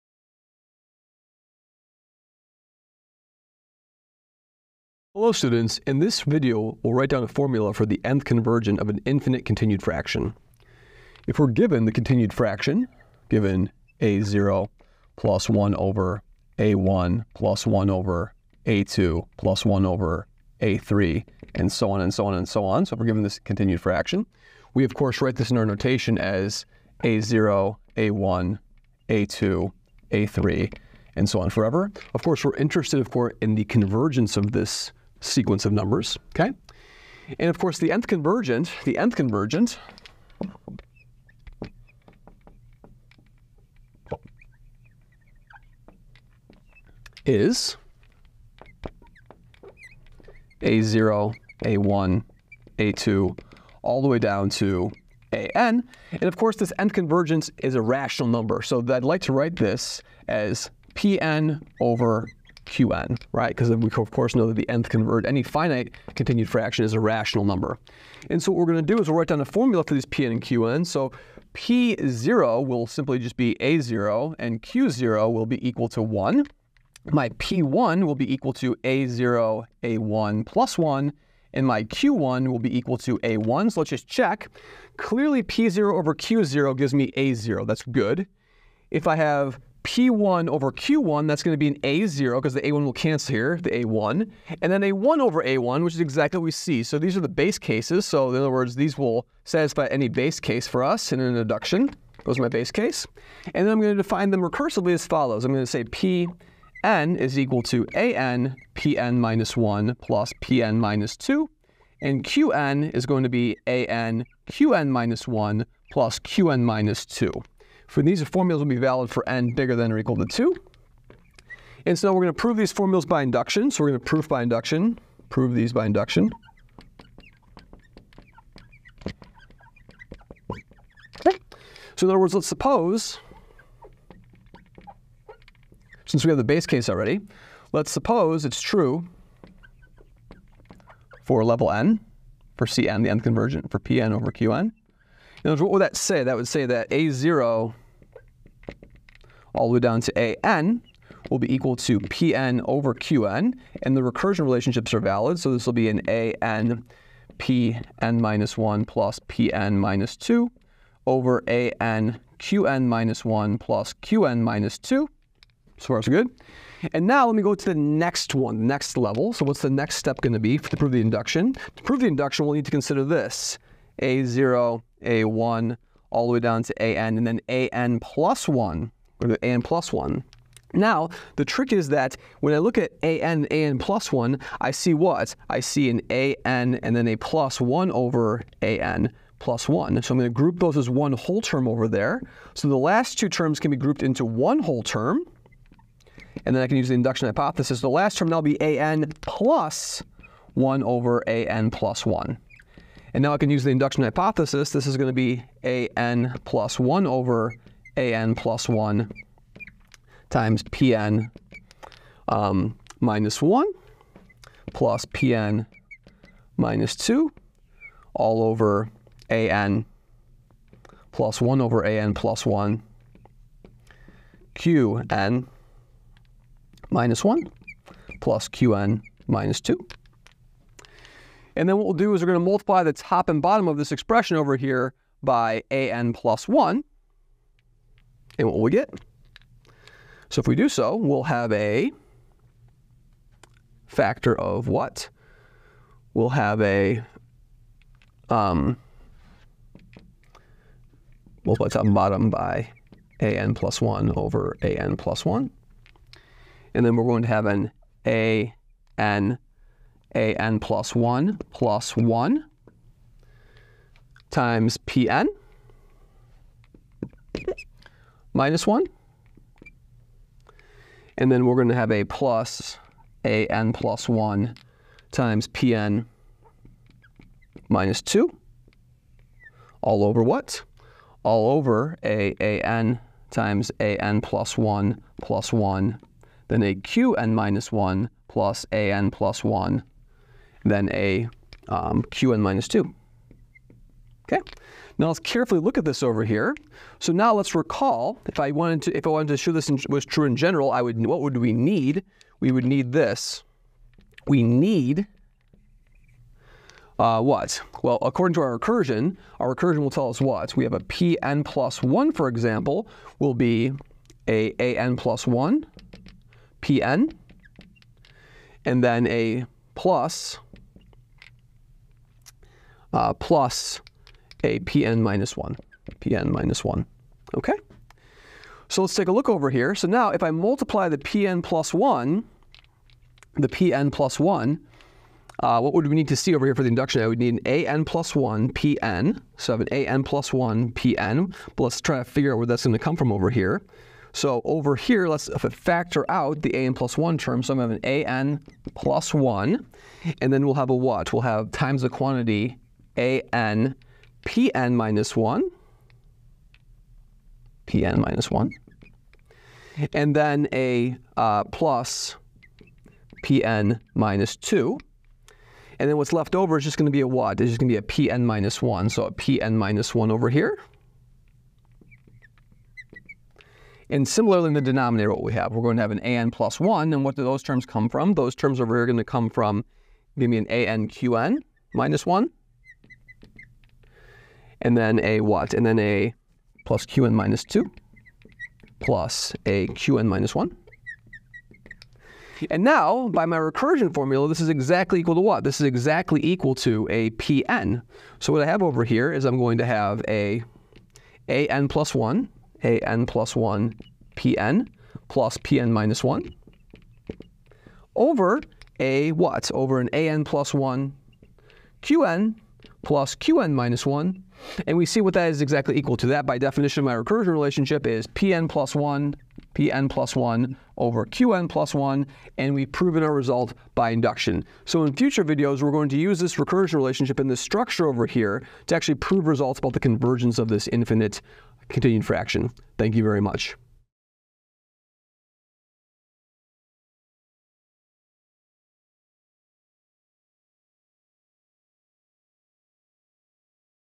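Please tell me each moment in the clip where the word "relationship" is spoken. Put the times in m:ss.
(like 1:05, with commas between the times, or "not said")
2:34, 6:57, 7:06.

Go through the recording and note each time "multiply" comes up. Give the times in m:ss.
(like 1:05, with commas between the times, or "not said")
3:52, 4:11, 5:30.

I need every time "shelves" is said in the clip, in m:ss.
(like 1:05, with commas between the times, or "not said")
not said.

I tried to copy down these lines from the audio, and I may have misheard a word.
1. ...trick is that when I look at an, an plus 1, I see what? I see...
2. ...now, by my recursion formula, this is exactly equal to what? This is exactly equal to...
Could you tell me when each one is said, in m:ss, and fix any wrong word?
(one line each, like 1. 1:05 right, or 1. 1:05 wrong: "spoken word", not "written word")
1. 3:01 right
2. 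6:32 right.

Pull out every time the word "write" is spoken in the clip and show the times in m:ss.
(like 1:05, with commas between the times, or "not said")
0:06, 0:25, 0:59, 1:09.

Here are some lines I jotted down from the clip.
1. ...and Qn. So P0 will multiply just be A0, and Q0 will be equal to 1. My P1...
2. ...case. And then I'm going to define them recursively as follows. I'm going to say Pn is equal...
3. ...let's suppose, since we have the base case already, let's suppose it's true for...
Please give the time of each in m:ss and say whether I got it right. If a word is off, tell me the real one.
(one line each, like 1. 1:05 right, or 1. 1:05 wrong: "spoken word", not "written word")
1. 1:10 wrong: "simply", not "multiply"
2. 1:42 right
3. 2:12 right.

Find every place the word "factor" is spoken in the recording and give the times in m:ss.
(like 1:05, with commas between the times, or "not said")
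4:03, 5:45.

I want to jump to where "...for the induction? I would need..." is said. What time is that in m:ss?
5:36.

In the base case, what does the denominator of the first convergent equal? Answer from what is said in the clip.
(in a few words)
A1.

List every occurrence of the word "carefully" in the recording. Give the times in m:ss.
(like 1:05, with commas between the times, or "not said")
4:55.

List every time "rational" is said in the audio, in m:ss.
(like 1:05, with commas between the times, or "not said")
0:57, 1:06.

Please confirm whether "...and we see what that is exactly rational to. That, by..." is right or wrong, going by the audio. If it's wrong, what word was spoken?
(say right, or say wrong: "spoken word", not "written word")
wrong: "equal", not "rational".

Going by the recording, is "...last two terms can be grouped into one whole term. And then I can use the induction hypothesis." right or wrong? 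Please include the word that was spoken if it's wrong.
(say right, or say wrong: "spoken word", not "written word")
right.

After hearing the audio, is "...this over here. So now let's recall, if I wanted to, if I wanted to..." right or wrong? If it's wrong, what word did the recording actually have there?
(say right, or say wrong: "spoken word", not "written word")
right.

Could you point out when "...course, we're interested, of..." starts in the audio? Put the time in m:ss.
0:32.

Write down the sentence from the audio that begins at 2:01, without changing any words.
And so we're going to prove these formulas by induction.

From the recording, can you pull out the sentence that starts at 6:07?
It's just going to be a pn minus 1.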